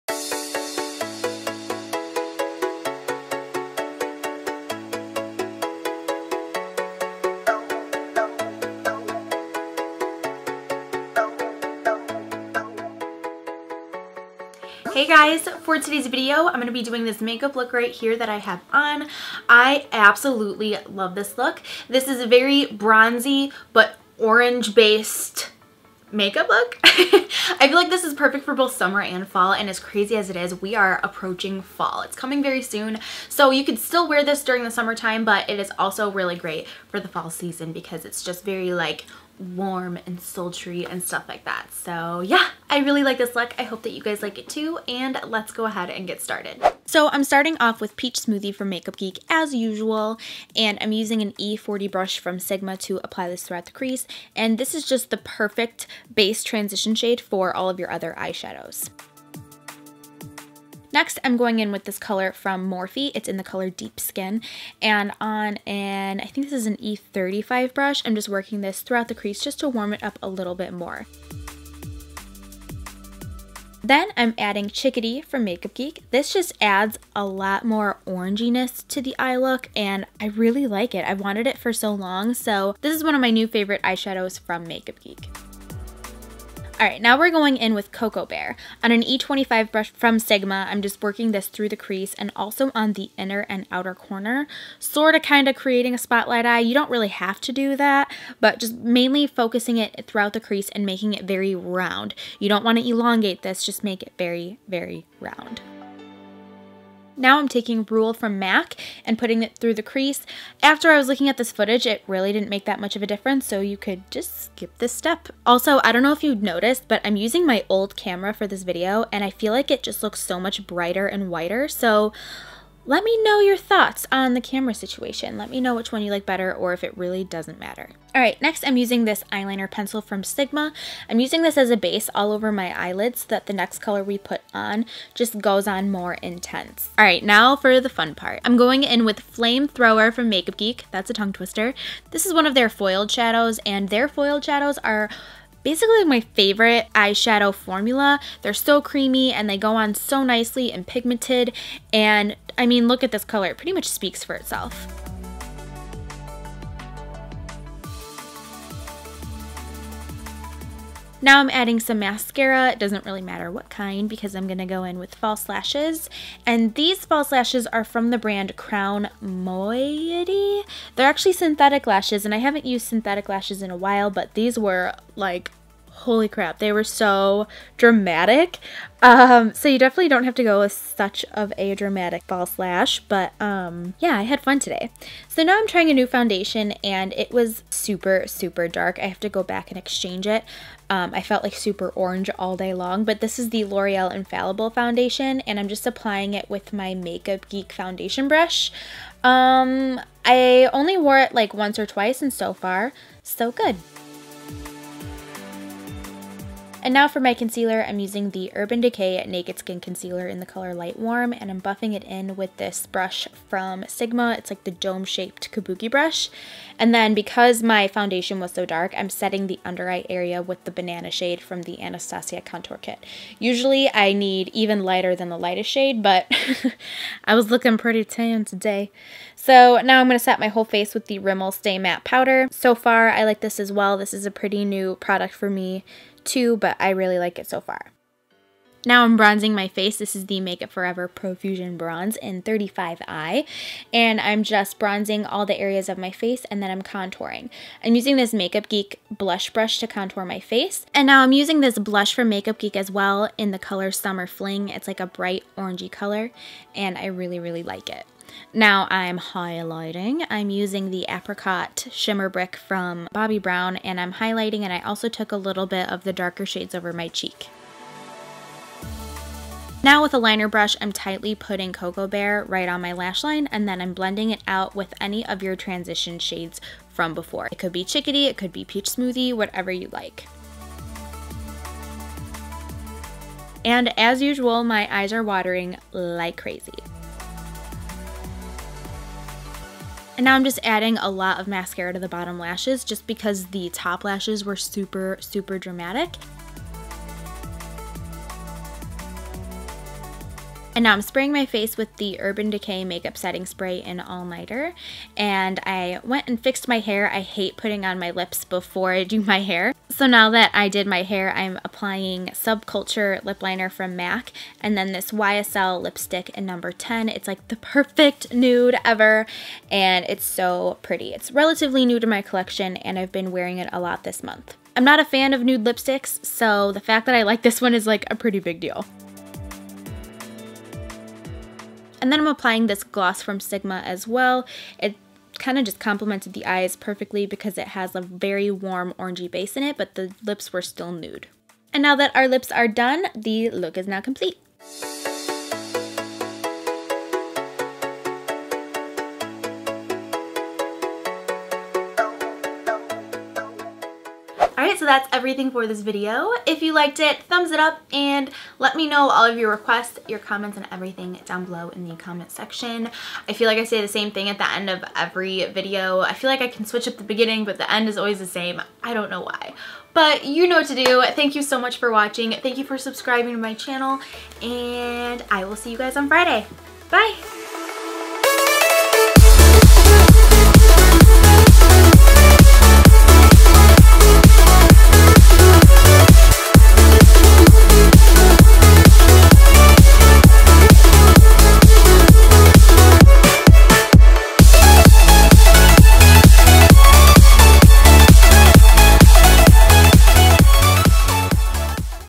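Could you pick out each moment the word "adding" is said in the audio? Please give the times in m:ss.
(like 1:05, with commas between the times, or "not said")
1:14, 2:41, 4:50.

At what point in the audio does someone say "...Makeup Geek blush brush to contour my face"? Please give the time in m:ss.
4:08.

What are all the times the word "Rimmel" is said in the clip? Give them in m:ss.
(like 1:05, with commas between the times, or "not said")
3:51.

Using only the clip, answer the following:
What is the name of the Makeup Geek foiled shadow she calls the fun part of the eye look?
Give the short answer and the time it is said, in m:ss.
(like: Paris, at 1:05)
Flamethrower, at 2:19.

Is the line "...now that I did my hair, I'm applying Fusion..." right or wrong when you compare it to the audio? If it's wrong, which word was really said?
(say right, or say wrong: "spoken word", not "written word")
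wrong: "Subculture", not "Fusion".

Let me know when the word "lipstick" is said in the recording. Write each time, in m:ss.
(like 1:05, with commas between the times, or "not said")
5:15, 5:25.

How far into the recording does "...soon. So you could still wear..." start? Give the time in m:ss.
0:32.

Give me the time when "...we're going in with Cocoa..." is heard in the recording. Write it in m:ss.
1:27.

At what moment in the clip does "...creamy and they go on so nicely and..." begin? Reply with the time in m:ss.
2:28.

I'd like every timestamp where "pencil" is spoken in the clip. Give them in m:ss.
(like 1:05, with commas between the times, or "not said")
2:09.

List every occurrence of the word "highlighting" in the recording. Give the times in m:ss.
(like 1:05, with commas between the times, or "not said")
4:19, 4:24.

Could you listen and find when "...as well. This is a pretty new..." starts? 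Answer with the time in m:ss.
3:53.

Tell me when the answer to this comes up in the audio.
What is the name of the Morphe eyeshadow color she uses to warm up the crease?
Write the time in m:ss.
1:03.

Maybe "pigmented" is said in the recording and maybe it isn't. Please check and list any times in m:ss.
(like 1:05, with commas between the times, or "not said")
2:30.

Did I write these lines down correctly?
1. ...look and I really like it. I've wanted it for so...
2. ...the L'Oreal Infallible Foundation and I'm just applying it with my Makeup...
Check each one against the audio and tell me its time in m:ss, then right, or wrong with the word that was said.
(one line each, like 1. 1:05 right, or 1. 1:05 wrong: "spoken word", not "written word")
1. 1:19 right
2. 3:13 right.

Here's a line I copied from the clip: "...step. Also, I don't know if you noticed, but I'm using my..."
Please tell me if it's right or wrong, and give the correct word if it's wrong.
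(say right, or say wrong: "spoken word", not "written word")
right.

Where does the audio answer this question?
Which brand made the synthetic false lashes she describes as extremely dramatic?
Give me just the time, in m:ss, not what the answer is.
2:48.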